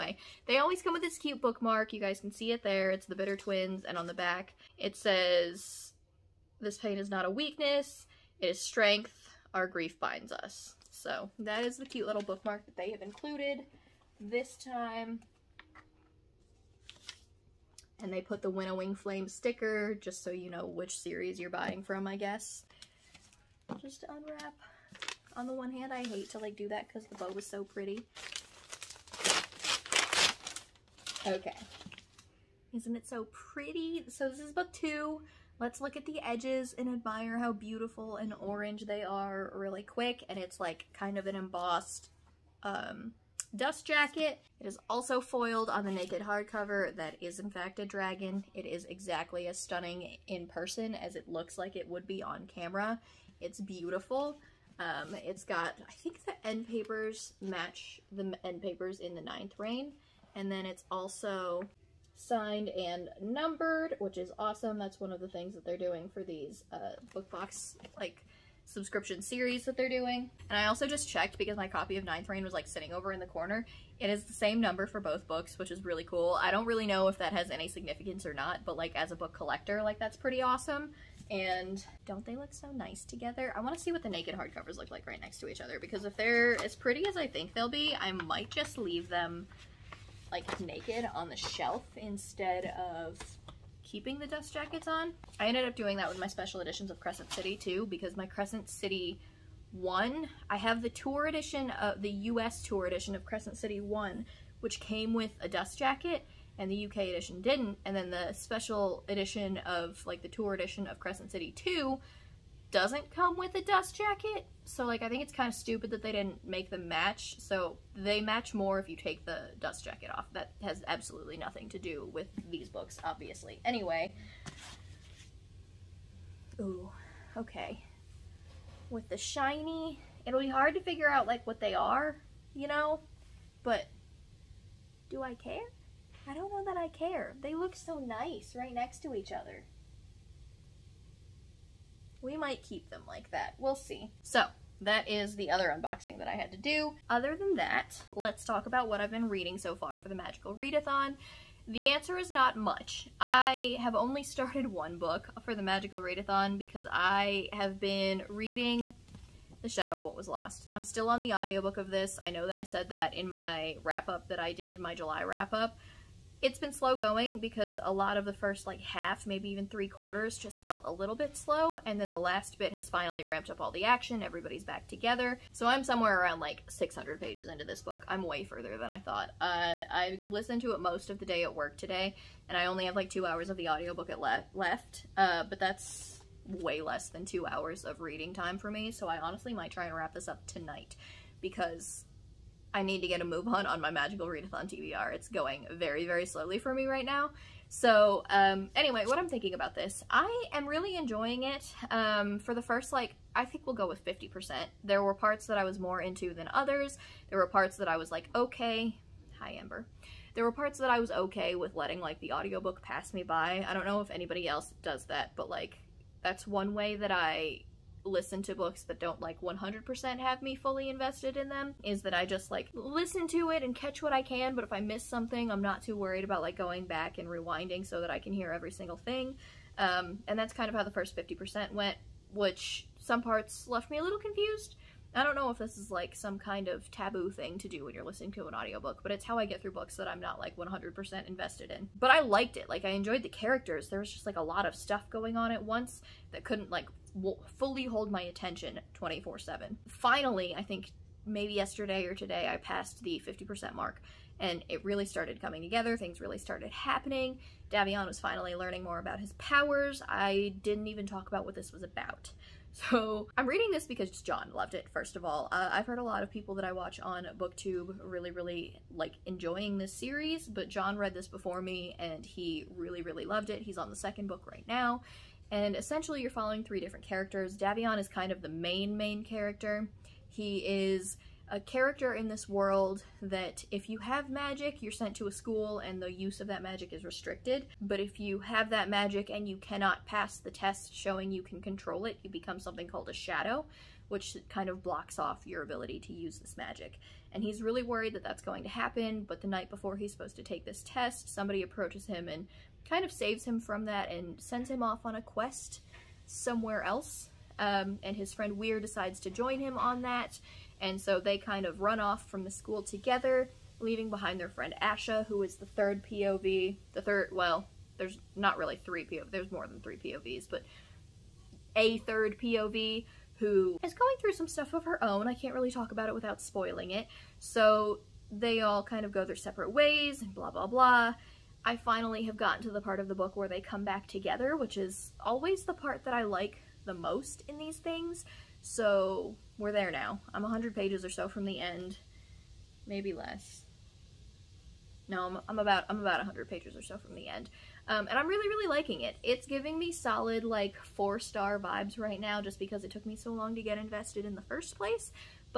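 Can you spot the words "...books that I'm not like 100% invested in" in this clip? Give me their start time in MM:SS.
03:59.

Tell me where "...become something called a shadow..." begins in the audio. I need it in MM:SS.
04:52.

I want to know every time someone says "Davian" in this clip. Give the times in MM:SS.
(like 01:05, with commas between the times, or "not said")
04:17, 04:37.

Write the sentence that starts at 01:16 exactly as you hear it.
I don't really know if that has any significance or not, but like as a book collector, like that's pretty awesome.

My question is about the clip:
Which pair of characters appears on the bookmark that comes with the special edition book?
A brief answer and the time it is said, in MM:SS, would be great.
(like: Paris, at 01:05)
The Bitter Twins, at 00:03.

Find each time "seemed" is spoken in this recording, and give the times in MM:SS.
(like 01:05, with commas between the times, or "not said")
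not said.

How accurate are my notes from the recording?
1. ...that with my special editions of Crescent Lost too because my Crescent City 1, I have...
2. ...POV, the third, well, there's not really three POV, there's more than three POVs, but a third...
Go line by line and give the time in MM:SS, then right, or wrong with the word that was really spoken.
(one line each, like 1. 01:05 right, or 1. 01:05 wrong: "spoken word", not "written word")
1. 01:35 wrong: "City", not "Lost"
2. 05:16 right.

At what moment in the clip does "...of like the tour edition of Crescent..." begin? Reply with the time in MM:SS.
01:49.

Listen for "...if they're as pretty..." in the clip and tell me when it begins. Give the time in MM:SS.
01:26.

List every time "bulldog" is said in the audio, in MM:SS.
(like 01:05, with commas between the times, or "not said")
not said.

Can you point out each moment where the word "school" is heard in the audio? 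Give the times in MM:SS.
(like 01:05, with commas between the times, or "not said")
04:45, 05:12.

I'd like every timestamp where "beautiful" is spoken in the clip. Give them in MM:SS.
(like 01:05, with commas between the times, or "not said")
00:37, 00:53.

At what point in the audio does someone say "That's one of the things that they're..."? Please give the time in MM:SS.
01:04.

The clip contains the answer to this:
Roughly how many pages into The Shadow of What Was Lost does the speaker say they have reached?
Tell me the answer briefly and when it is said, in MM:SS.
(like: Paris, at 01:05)
600, at 02:56.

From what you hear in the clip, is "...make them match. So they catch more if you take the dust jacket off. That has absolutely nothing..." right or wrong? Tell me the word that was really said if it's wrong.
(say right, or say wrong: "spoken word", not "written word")
wrong: "match", not "catch".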